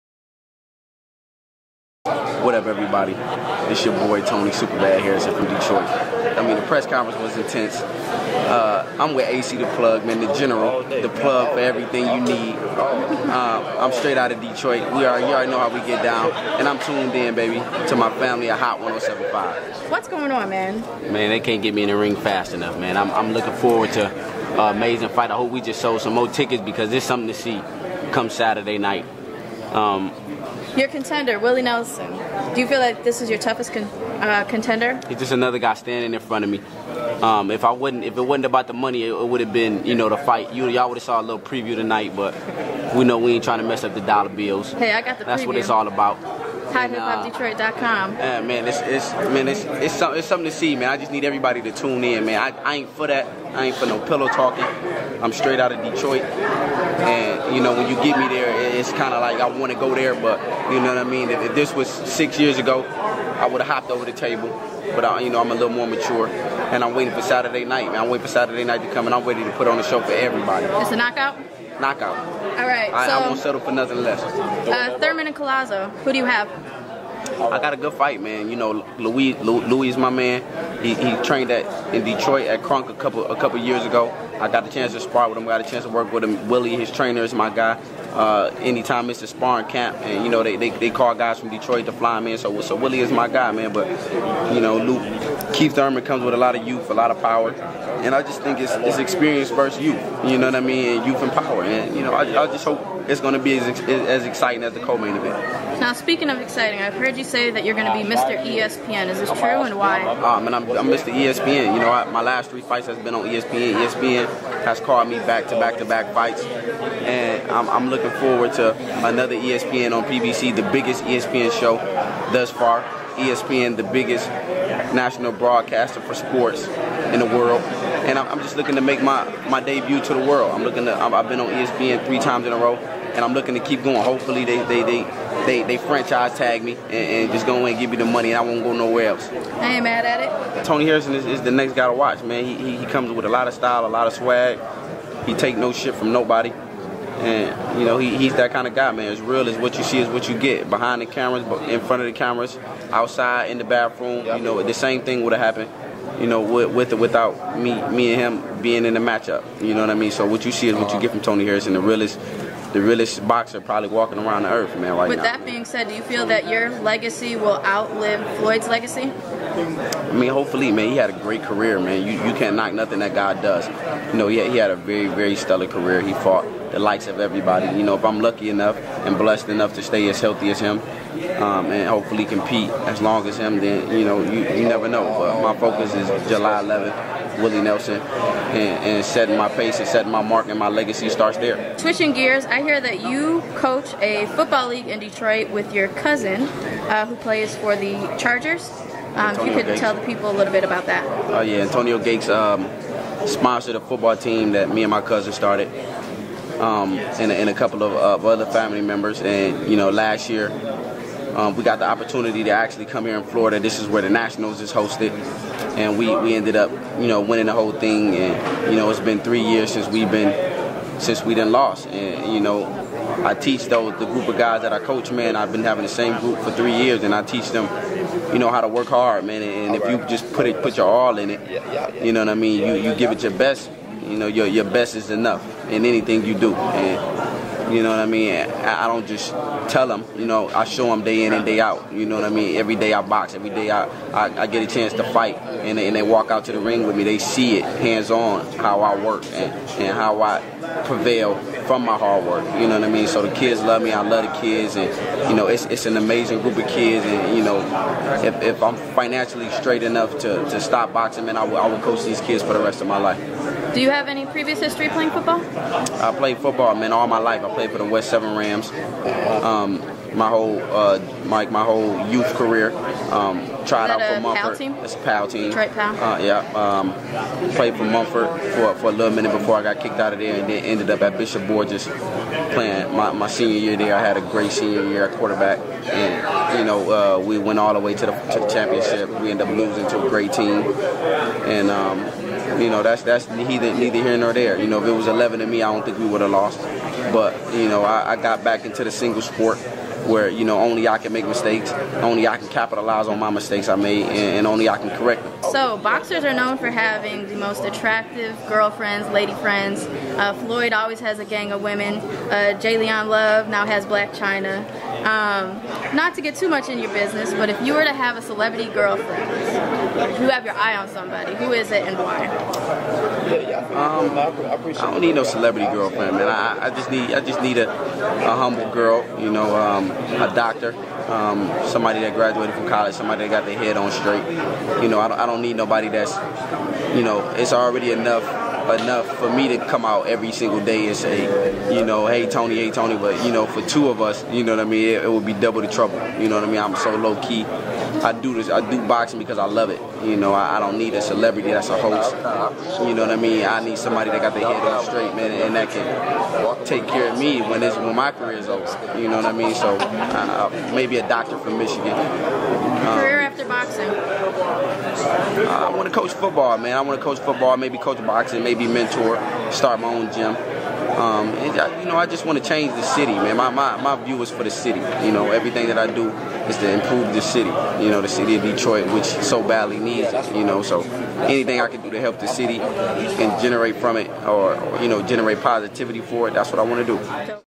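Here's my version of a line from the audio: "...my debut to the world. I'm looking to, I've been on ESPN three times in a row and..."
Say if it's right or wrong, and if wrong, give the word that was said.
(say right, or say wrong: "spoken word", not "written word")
right.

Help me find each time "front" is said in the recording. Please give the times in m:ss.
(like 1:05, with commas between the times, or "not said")
0:36, 2:31.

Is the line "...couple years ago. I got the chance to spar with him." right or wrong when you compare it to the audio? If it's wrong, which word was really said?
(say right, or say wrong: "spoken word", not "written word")
right.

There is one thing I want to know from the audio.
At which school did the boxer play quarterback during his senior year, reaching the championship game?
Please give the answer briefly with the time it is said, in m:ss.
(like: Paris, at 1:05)
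Bishop Borgess, at 4:41.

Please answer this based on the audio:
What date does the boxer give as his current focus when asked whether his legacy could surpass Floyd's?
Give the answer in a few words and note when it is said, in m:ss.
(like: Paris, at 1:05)
July 11th, at 3:06.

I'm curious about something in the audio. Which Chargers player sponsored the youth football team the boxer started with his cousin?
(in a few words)
Antonio Gates.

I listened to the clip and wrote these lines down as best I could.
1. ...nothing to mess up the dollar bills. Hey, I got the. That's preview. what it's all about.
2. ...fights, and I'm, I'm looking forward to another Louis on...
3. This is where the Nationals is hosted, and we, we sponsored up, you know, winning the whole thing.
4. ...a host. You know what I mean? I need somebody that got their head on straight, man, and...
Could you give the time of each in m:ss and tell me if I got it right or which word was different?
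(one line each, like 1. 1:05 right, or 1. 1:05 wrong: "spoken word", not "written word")
1. 0:43 wrong: "trying", not "nothing"
2. 1:56 wrong: "ESPN", not "Louis"
3. 3:33 wrong: "ended", not "sponsored"
4. 5:51 right.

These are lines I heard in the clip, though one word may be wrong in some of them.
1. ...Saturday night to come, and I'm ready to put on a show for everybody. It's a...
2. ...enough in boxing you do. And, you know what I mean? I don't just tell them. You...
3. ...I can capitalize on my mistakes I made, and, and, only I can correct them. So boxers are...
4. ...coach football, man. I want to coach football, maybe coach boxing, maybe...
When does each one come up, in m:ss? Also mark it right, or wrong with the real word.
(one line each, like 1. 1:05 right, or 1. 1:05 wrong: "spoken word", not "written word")
1. 1:08 right
2. 3:55 wrong: "anything", not "boxing"
3. 5:02 right
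4. 6:05 right.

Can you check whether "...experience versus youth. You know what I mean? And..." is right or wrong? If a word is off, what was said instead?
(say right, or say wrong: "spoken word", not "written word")
right.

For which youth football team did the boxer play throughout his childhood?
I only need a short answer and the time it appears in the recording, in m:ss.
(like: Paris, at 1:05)
West Seven Rams, at 4:27.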